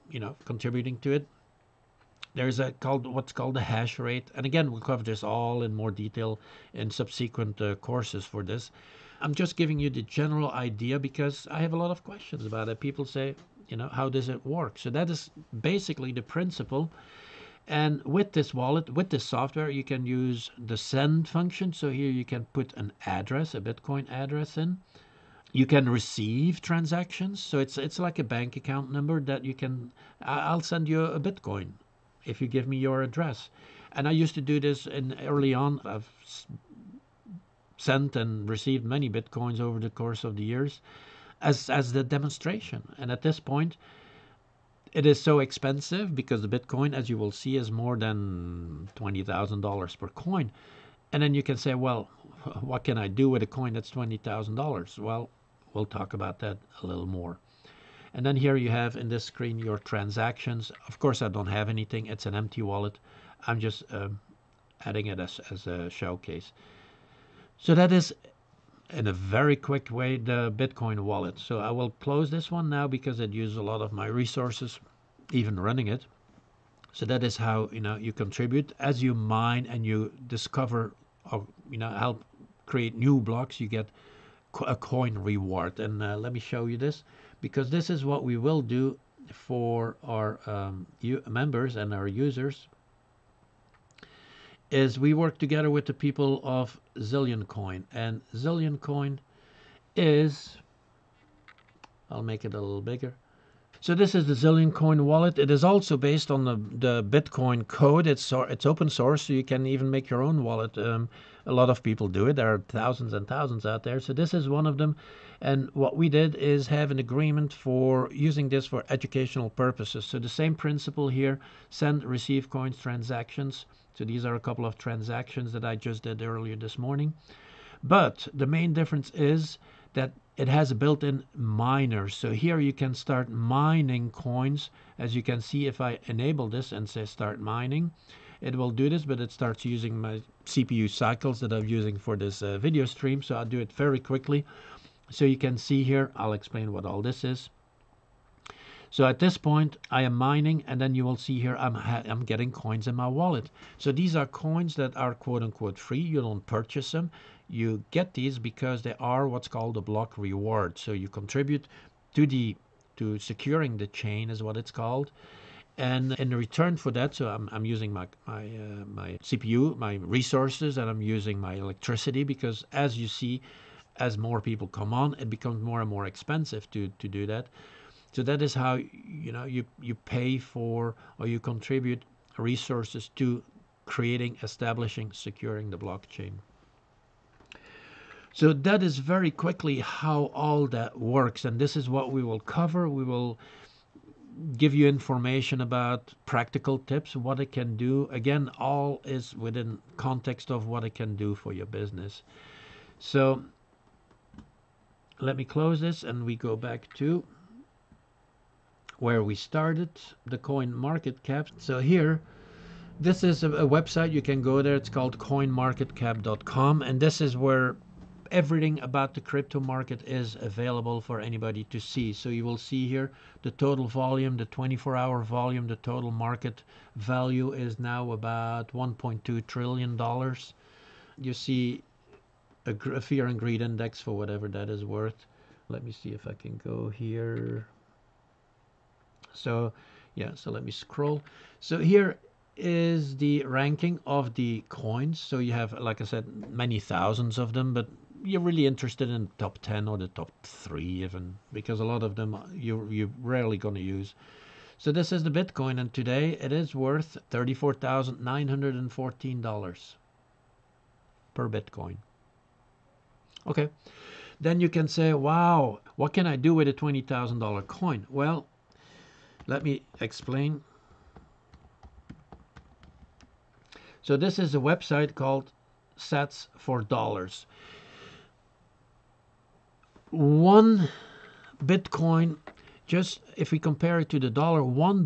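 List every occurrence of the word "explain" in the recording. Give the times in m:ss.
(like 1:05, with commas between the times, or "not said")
2:26, 4:29.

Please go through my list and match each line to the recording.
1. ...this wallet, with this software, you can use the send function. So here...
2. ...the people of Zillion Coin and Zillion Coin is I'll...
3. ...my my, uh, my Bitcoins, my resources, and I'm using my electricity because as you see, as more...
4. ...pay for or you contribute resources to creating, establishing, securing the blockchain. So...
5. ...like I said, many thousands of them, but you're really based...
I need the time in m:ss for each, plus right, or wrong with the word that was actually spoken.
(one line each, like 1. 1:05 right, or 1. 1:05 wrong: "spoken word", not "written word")
1. 0:18 right
2. 1:35 right
3. 2:47 wrong: "CPU", not "Bitcoins"
4. 2:59 right
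5. 4:05 wrong: "interested", not "based".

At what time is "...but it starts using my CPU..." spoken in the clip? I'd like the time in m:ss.
2:19.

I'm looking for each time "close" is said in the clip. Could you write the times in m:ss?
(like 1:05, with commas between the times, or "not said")
1:11, 3:25.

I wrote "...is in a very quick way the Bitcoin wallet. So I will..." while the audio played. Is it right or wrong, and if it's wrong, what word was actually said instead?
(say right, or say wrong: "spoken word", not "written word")
right.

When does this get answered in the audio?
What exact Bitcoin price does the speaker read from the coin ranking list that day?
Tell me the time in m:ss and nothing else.
4:17.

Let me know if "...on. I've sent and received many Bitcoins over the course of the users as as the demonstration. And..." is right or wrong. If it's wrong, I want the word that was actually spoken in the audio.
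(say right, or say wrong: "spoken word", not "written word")
wrong: "years", not "users".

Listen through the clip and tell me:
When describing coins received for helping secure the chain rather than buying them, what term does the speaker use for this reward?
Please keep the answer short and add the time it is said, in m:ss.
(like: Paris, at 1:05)
block reward, at 2:39.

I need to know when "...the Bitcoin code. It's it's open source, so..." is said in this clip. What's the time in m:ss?
1:46.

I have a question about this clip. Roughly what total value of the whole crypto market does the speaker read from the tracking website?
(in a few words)
1.2 trillion dollars.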